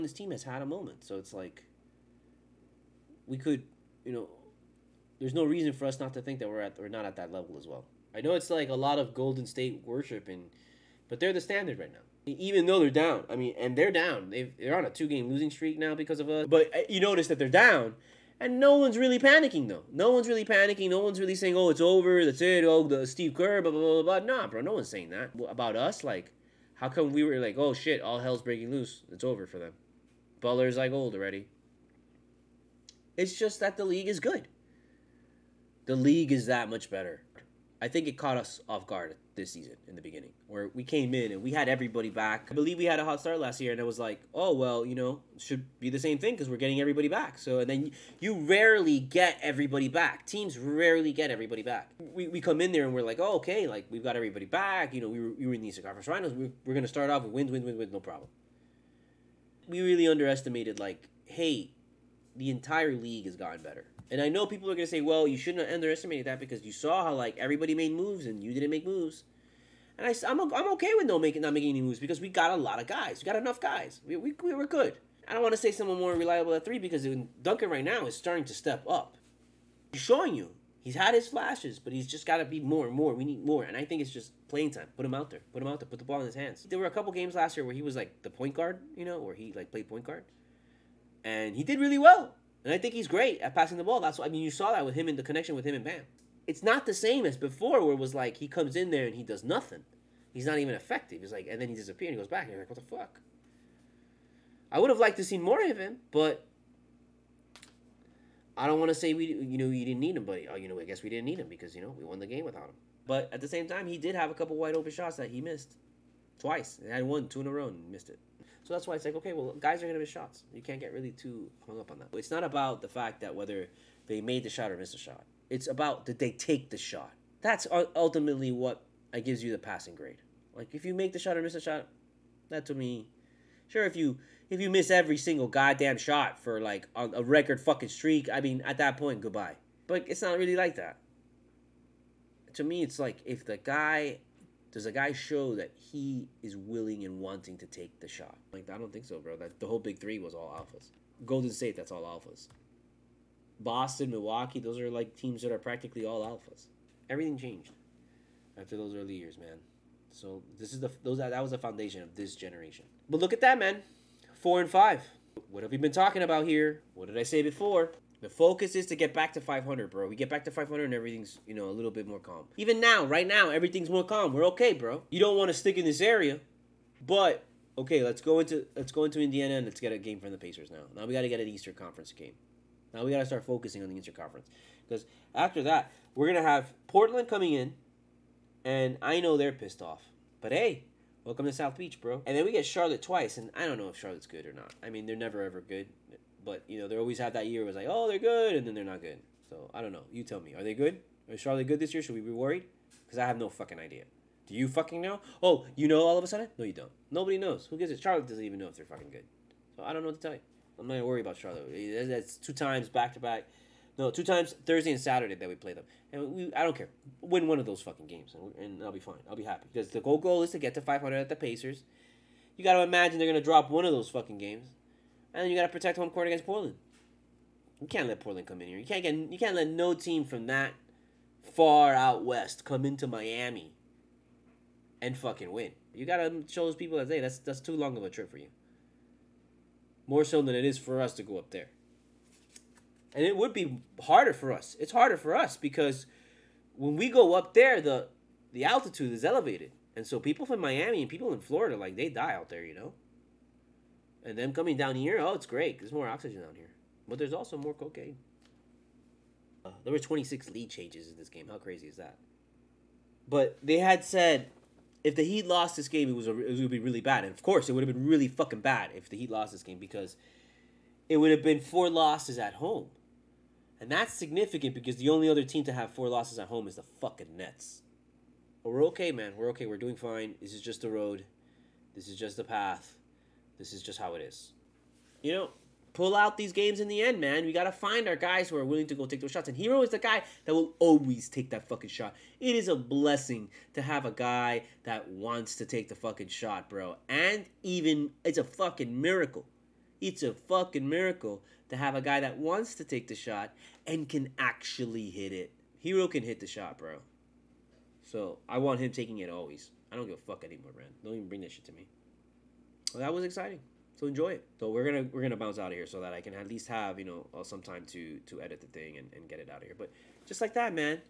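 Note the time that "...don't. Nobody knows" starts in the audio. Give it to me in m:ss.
3:26.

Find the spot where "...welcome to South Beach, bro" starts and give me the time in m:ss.
3:11.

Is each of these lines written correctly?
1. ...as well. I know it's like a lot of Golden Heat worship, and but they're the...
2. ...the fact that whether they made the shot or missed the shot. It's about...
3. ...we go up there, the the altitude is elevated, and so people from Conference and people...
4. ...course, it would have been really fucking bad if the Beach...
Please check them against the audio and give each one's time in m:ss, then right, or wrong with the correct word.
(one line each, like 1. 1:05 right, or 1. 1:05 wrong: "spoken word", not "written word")
1. 0:07 wrong: "State", not "Heat"
2. 2:02 right
3. 4:06 wrong: "Miami", not "Conference"
4. 4:27 wrong: "Heat", not "Beach".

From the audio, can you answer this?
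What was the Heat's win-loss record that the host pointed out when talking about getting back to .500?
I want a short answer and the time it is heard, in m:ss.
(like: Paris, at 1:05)
4 and 5, at 2:44.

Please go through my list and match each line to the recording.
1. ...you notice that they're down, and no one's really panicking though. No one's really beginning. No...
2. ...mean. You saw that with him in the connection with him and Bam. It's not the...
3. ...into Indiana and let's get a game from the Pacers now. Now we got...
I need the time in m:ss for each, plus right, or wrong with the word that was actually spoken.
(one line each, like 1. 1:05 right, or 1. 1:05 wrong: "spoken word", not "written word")
1. 0:16 wrong: "panicking", not "beginning"
2. 1:34 right
3. 2:59 right.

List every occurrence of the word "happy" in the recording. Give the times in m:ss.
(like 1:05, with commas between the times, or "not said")
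3:39.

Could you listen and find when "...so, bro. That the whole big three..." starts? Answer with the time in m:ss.
2:29.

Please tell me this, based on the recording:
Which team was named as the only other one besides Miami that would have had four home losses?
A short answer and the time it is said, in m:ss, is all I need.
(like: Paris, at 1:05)
Nets, at 4:37.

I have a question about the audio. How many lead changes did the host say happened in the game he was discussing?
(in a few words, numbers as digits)
26.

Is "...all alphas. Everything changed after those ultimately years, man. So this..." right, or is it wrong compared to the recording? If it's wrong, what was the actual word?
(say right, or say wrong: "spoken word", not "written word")
wrong: "early", not "ultimately".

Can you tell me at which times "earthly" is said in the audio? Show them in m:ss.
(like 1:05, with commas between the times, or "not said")
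not said.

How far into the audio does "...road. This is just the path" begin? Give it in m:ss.
4:40.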